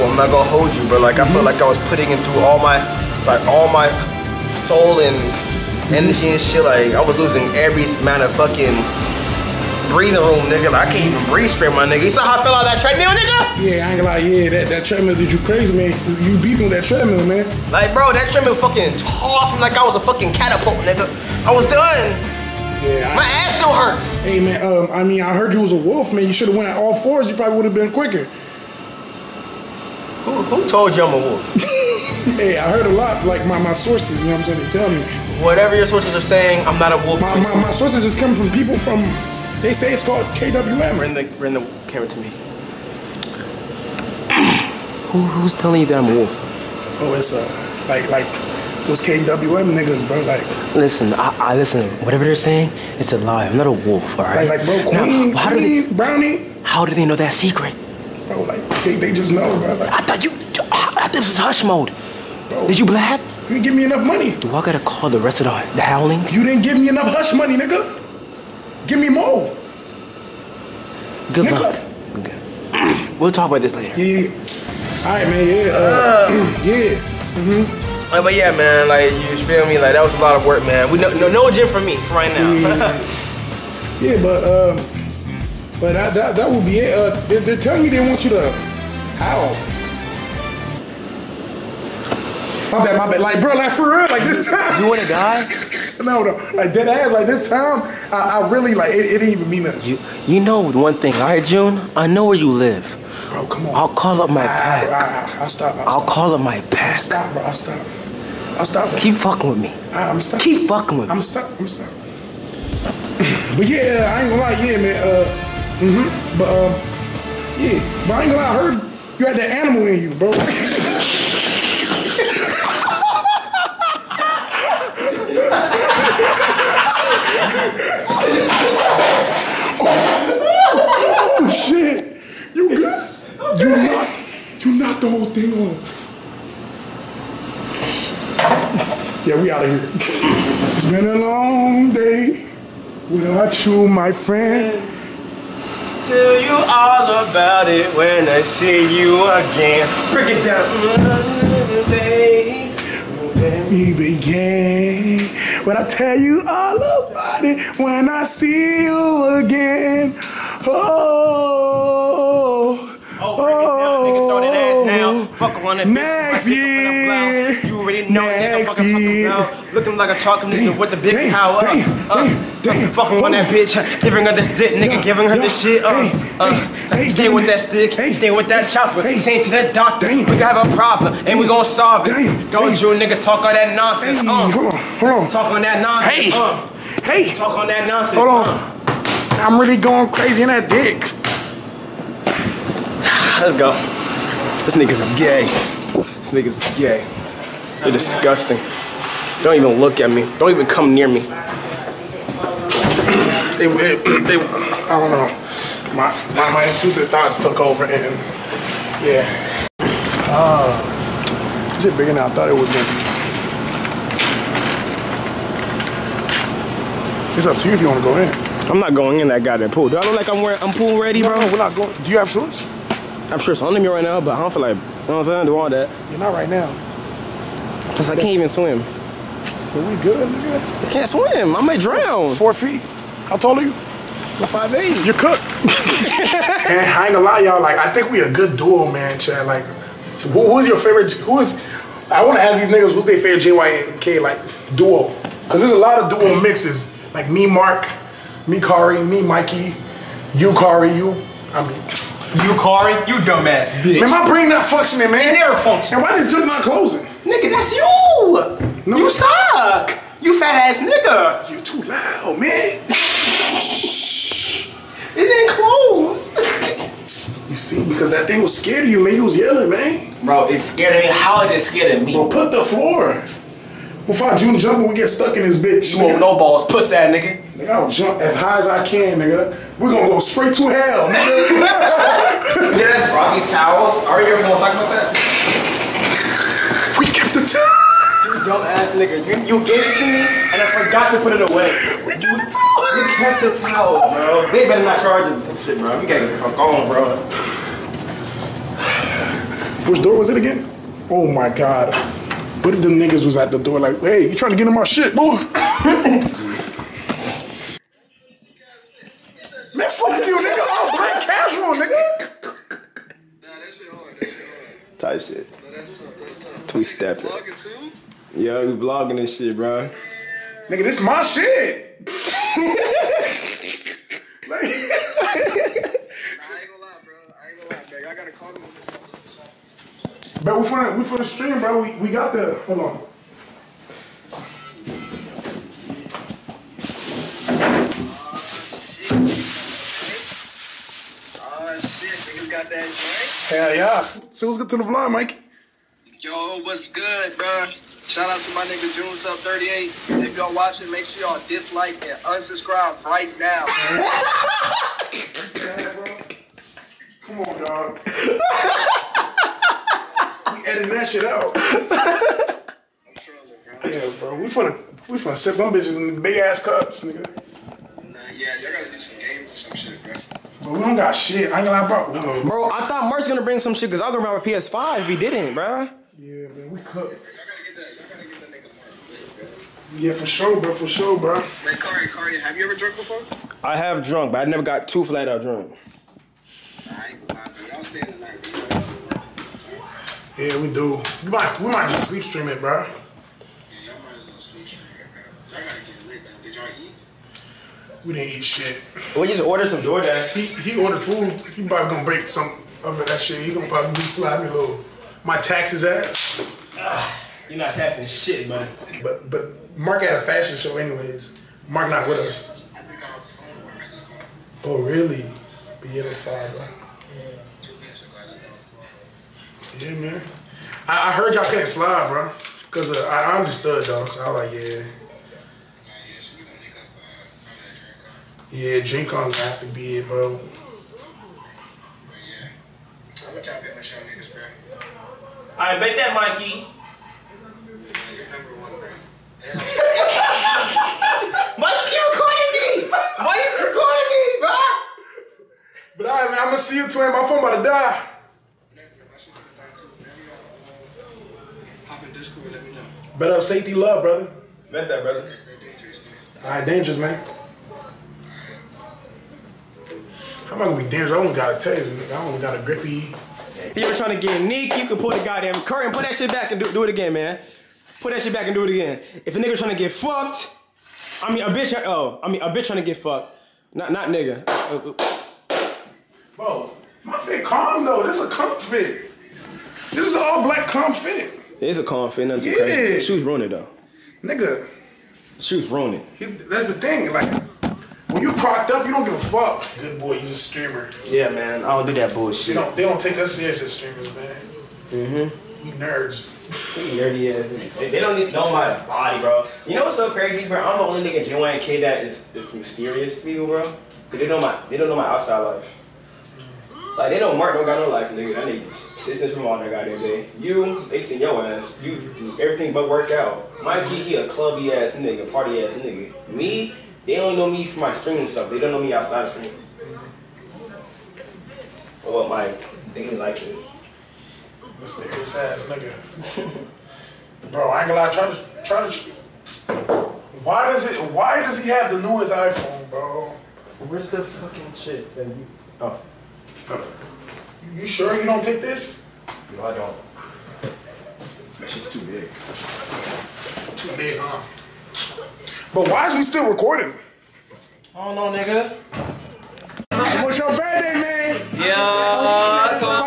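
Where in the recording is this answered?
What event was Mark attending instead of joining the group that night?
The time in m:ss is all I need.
6:49.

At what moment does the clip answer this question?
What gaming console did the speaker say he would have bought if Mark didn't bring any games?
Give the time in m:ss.
6:14.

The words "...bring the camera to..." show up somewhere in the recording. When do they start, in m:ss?
0:41.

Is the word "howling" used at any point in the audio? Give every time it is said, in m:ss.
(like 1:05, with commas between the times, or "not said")
1:05.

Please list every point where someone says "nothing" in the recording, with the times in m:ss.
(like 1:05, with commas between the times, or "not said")
1:39, 8:02.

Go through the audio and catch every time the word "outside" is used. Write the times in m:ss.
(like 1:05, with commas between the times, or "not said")
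8:25, 8:38.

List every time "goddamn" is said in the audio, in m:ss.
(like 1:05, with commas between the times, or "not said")
3:39, 7:45, 8:29.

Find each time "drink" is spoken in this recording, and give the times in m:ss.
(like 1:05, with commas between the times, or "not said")
7:08.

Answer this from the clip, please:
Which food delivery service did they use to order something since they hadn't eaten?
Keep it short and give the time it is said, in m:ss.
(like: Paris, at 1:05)
DoorDash, at 6:39.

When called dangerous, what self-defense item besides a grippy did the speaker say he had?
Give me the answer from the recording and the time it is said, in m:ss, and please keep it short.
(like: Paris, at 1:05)
taser, at 7:41.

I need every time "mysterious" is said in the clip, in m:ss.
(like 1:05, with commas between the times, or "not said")
8:22, 8:44.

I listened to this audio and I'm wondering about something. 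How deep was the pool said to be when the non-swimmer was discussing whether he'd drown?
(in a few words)
4 feet.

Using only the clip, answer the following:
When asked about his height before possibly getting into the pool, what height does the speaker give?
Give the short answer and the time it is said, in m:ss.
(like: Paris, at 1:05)
5'8", at 3:54.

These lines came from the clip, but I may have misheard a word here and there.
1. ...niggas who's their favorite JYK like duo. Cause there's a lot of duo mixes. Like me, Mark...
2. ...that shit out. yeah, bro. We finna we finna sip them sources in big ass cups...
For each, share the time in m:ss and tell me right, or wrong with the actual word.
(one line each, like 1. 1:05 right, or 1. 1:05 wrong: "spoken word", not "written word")
1. 4:02 right
2. 6:00 wrong: "bitches", not "sources".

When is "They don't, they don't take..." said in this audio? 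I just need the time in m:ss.
8:12.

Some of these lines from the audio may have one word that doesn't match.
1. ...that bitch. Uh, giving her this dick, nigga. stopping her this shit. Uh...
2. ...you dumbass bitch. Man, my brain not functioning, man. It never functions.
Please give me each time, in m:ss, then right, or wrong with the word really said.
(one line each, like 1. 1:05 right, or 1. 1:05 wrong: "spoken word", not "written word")
1. 2:53 wrong: "giving", not "stopping"
2. 4:13 right.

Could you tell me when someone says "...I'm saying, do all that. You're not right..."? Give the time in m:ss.
3:45.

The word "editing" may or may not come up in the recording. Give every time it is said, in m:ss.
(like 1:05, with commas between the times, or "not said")
6:00.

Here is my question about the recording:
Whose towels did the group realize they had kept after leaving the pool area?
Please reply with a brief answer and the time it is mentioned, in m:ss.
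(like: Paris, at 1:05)
Rocky, at 4:42.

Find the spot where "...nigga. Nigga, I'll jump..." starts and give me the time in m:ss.
4:37.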